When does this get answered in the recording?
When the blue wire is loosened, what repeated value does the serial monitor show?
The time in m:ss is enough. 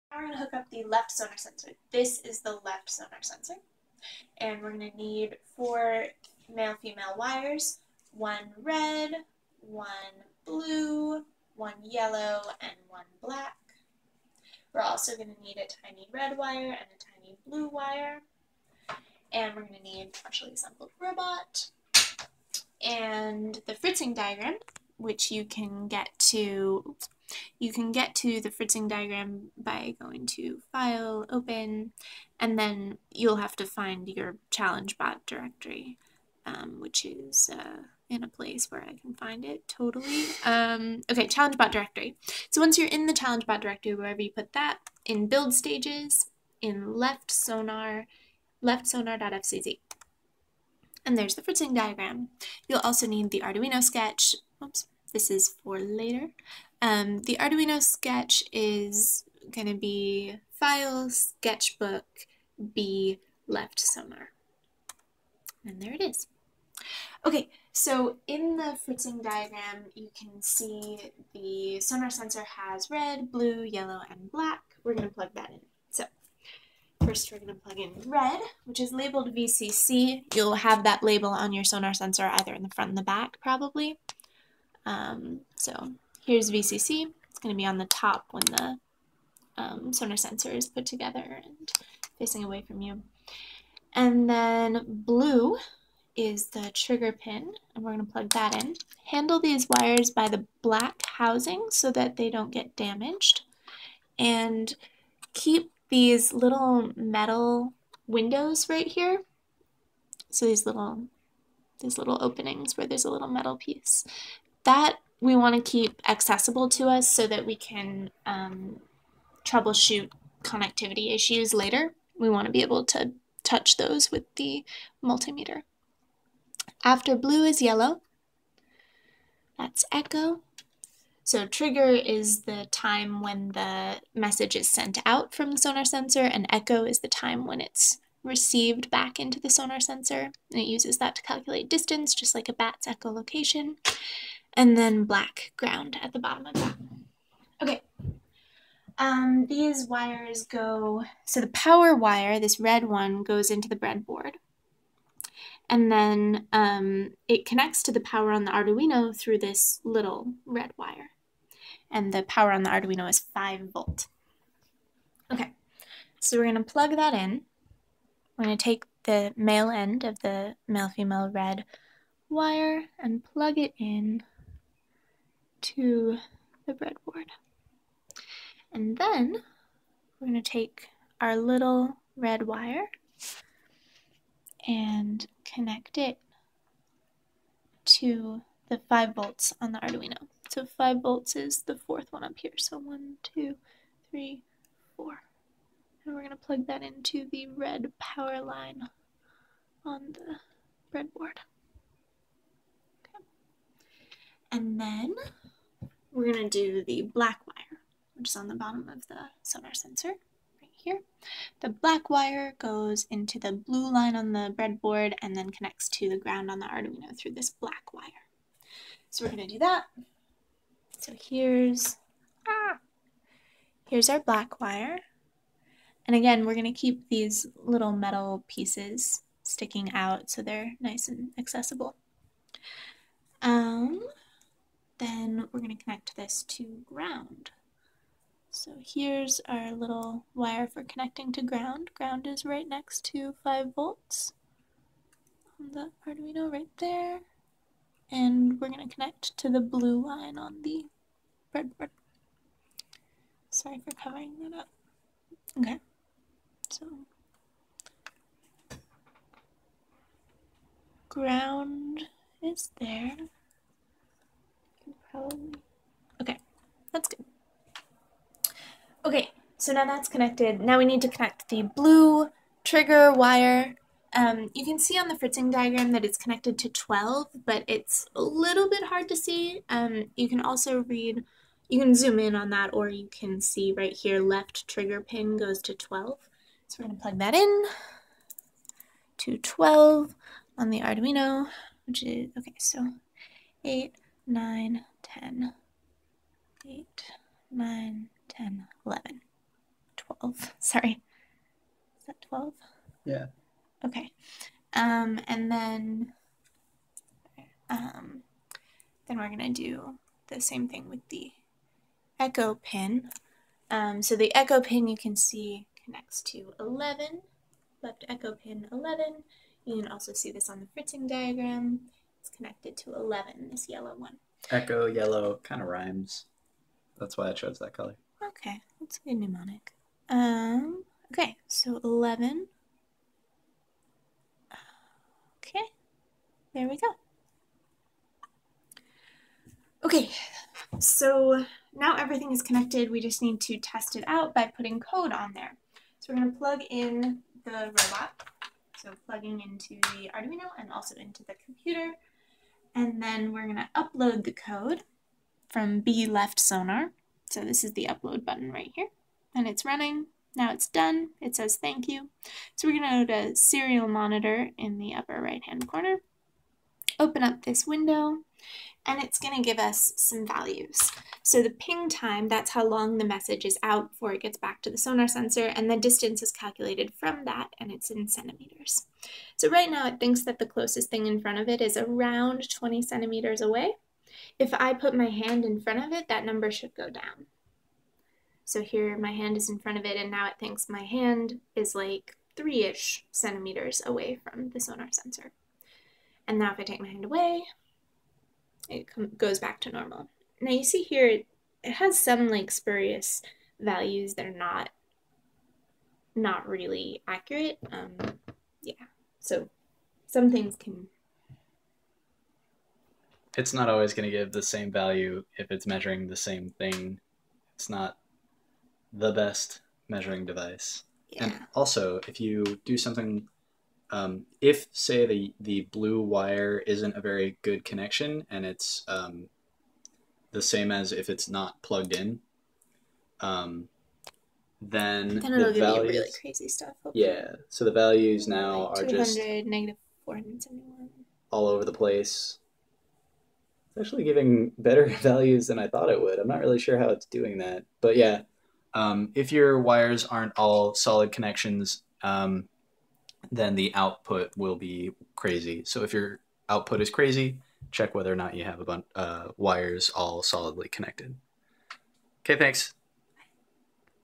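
7:19.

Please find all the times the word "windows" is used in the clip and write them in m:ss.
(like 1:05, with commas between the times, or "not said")
1:48, 6:07.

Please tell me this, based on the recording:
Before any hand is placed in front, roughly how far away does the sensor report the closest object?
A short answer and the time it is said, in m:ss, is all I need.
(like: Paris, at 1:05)
20 centimeters, at 6:21.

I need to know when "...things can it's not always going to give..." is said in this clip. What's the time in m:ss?
6:50.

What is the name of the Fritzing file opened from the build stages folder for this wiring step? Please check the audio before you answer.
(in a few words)
left sonar.fcz.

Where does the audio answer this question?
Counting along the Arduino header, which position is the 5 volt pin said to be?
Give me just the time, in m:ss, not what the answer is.
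3:11.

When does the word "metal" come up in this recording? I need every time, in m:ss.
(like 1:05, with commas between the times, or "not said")
1:46, 1:53, 3:47.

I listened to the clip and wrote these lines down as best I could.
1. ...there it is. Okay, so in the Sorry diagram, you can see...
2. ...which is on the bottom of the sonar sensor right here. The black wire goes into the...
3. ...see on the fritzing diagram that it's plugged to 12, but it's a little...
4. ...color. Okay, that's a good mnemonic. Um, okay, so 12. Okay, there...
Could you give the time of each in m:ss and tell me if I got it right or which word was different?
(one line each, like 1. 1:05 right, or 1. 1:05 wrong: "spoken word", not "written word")
1. 1:05 wrong: "Fritzing", not "Sorry"
2. 3:28 right
3. 4:34 wrong: "connected", not "plugged"
4. 5:27 wrong: "11", not "12".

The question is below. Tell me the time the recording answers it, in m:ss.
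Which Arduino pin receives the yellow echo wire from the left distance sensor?
5:17.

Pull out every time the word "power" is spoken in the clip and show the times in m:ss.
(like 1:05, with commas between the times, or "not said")
2:31, 2:38, 2:42, 3:17.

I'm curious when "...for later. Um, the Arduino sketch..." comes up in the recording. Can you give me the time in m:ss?
0:55.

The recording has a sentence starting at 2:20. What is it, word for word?
And it uses that to calculate distance, just like a bat's echolocation and then black ground at the bottom of that.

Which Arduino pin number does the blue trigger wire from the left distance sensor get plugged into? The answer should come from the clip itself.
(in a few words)
12.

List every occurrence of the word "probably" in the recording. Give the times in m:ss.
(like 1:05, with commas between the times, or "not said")
1:23, 4:25.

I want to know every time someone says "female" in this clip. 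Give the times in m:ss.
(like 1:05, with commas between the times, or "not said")
0:06, 2:50.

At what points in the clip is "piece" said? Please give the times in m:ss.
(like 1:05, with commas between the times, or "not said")
1:53, 3:48.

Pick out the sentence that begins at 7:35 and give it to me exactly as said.
So if your output is crazy, check whether or not you have a bunch uh, wires all solidly connected.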